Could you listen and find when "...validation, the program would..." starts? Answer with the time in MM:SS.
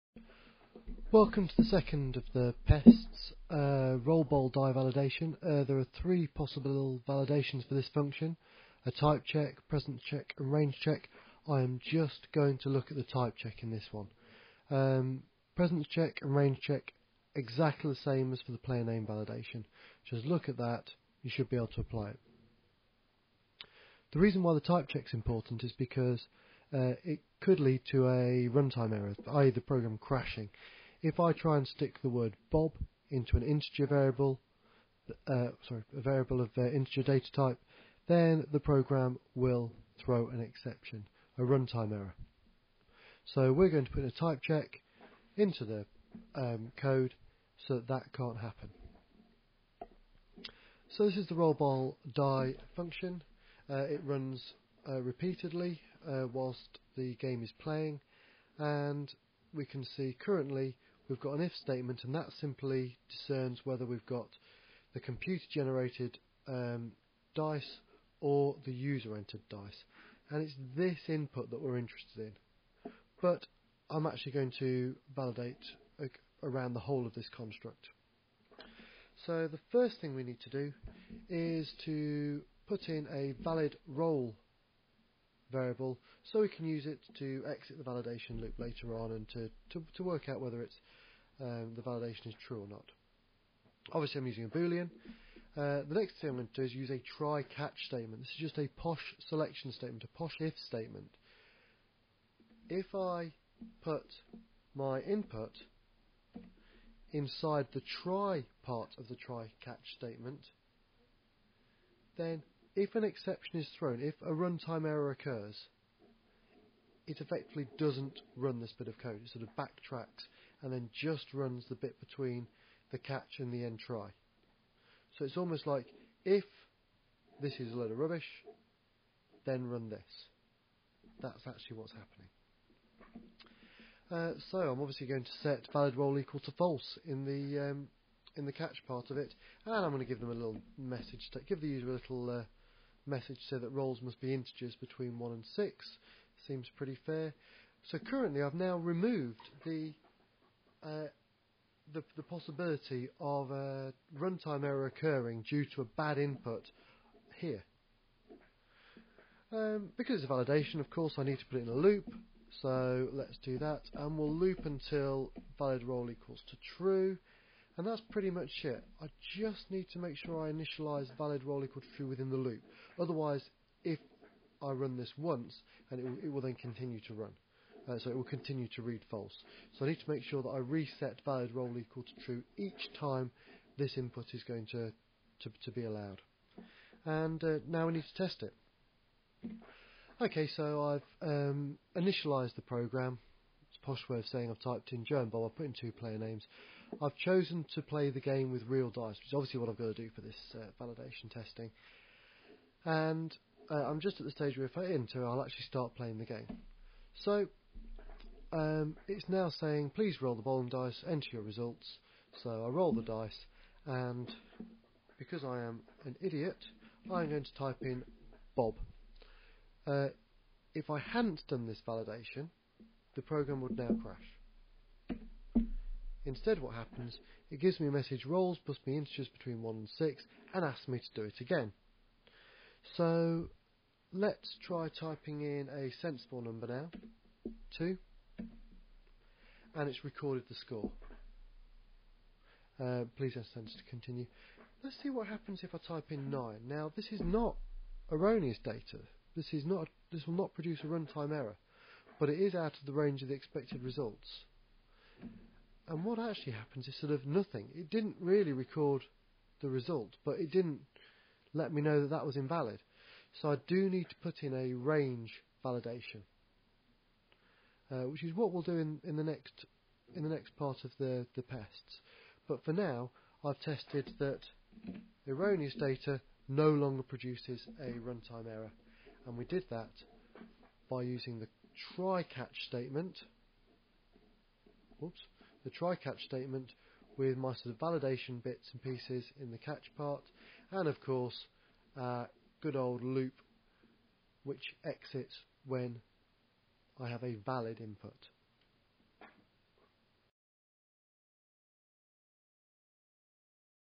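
03:41.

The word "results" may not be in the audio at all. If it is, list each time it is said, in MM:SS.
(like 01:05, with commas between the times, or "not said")
03:31, 04:13, 04:19.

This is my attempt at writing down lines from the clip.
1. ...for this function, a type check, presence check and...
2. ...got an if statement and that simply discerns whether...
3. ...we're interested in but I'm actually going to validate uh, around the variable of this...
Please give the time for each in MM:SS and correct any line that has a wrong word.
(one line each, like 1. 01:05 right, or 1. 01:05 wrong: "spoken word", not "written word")
1. 00:07 right
2. 01:01 right
3. 01:11 wrong: "whole", not "variable".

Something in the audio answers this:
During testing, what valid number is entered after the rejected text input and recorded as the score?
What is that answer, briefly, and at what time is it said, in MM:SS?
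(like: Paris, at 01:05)
2, at 03:57.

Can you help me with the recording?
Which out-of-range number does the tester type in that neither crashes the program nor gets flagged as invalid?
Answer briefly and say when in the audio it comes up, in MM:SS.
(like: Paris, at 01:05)
9, at 04:06.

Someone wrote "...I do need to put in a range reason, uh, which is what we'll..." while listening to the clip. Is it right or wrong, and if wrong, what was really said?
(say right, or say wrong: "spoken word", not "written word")
wrong: "validation", not "reason".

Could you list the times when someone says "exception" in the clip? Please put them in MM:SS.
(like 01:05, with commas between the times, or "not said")
00:40, 01:53.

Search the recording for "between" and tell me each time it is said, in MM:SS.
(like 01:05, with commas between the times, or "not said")
02:01, 02:24, 03:49.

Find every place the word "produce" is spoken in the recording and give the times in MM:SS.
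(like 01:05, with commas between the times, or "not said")
04:10, 04:37.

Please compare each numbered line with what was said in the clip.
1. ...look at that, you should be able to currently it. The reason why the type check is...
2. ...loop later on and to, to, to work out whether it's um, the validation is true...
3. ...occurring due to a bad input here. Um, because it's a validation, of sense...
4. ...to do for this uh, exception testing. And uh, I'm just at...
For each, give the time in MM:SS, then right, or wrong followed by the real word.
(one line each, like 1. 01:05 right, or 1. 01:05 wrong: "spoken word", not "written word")
1. 00:20 wrong: "apply", not "currently"
2. 01:28 right
3. 02:34 wrong: "course", not "sense"
4. 03:19 wrong: "validation", not "exception".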